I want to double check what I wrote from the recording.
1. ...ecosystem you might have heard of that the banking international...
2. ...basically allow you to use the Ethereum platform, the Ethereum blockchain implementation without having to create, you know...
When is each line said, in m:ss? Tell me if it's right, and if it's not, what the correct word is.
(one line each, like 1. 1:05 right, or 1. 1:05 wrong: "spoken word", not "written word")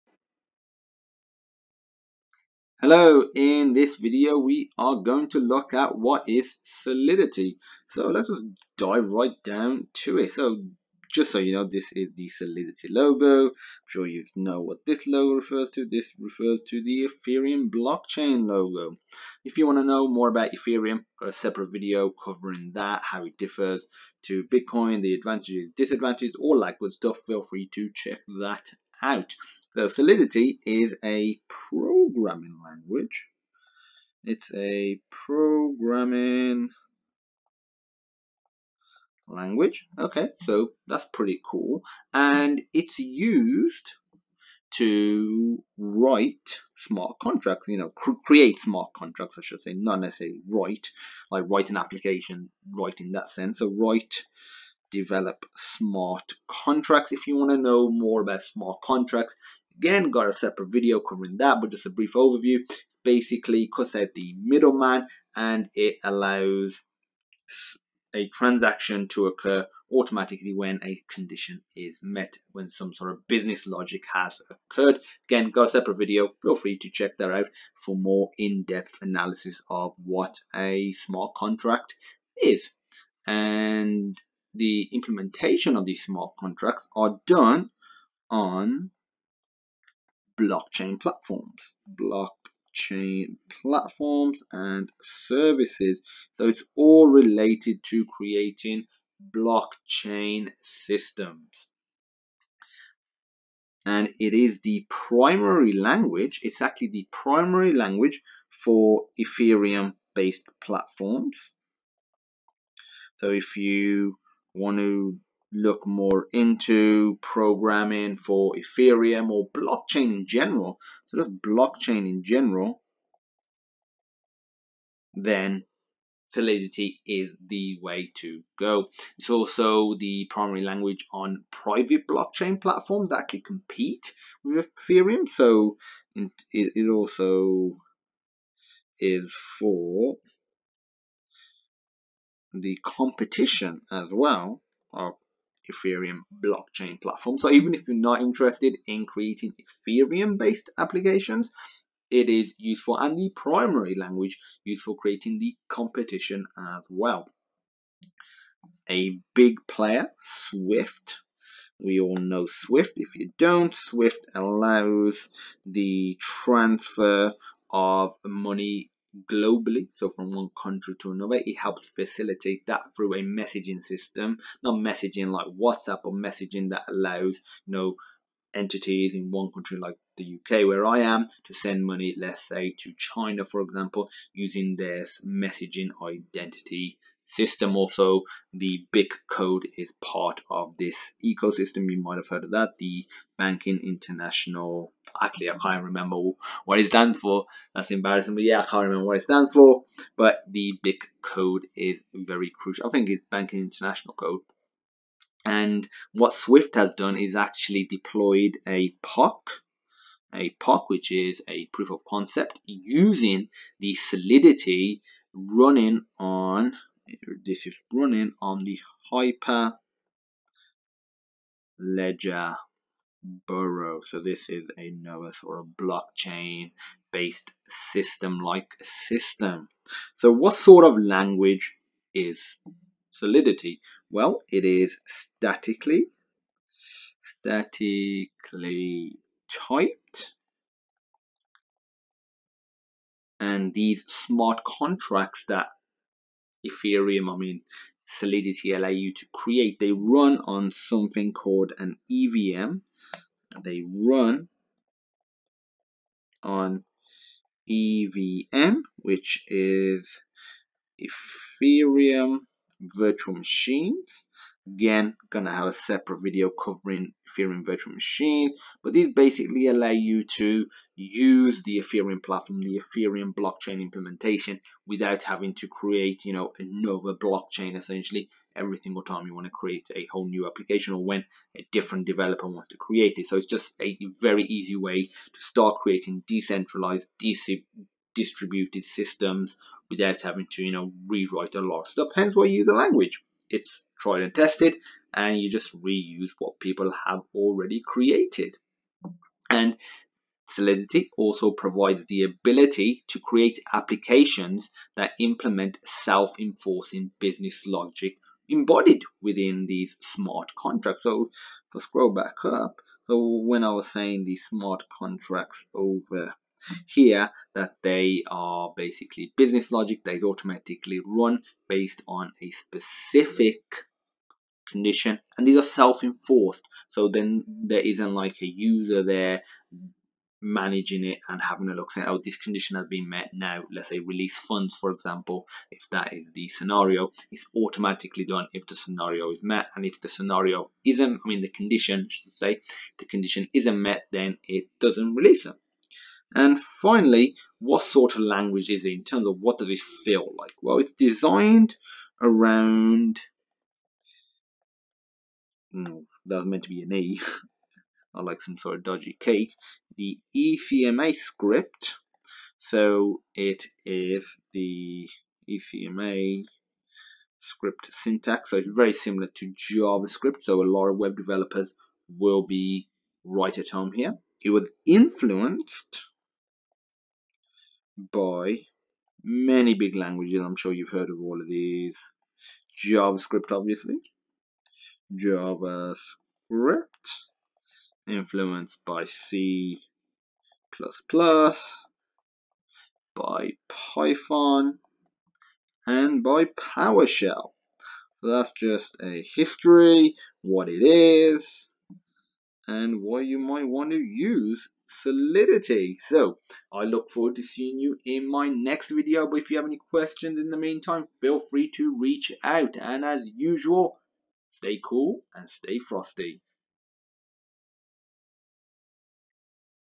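1. 3:11 right
2. 4:29 right.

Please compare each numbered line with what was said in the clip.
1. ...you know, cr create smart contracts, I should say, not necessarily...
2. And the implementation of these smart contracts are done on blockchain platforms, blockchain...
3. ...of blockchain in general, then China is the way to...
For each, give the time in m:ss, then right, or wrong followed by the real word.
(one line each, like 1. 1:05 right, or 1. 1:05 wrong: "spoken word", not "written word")
1. 0:47 right
2. 1:23 right
3. 2:01 wrong: "Solidity", not "China".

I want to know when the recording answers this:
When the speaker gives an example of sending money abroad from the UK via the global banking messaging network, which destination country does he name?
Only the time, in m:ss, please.
3:02.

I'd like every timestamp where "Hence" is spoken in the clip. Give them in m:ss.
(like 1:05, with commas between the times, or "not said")
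4:52.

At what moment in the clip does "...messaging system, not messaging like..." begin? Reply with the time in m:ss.
2:53.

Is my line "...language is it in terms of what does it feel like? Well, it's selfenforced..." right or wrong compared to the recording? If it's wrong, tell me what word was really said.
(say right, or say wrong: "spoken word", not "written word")
wrong: "designed", not "selfenforced".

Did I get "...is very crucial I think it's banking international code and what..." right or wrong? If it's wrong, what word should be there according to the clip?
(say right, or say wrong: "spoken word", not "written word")
right.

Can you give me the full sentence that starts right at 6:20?
I'm sure you've heard of all of these.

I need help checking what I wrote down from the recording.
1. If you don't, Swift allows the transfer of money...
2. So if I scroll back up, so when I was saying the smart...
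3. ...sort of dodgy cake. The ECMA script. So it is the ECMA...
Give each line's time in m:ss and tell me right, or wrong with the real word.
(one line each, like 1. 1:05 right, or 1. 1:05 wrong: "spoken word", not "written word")
1. 2:42 right
2. 5:11 right
3. 5:58 right.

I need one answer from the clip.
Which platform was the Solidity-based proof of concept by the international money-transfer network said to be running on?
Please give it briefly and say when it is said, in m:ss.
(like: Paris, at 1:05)
Hyperledger Burrow, at 3:41.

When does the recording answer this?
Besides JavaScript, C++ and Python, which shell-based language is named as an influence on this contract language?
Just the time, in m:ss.
6:36.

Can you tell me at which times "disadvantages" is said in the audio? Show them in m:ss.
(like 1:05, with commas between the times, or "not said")
0:25.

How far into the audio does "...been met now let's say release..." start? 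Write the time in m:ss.
5:32.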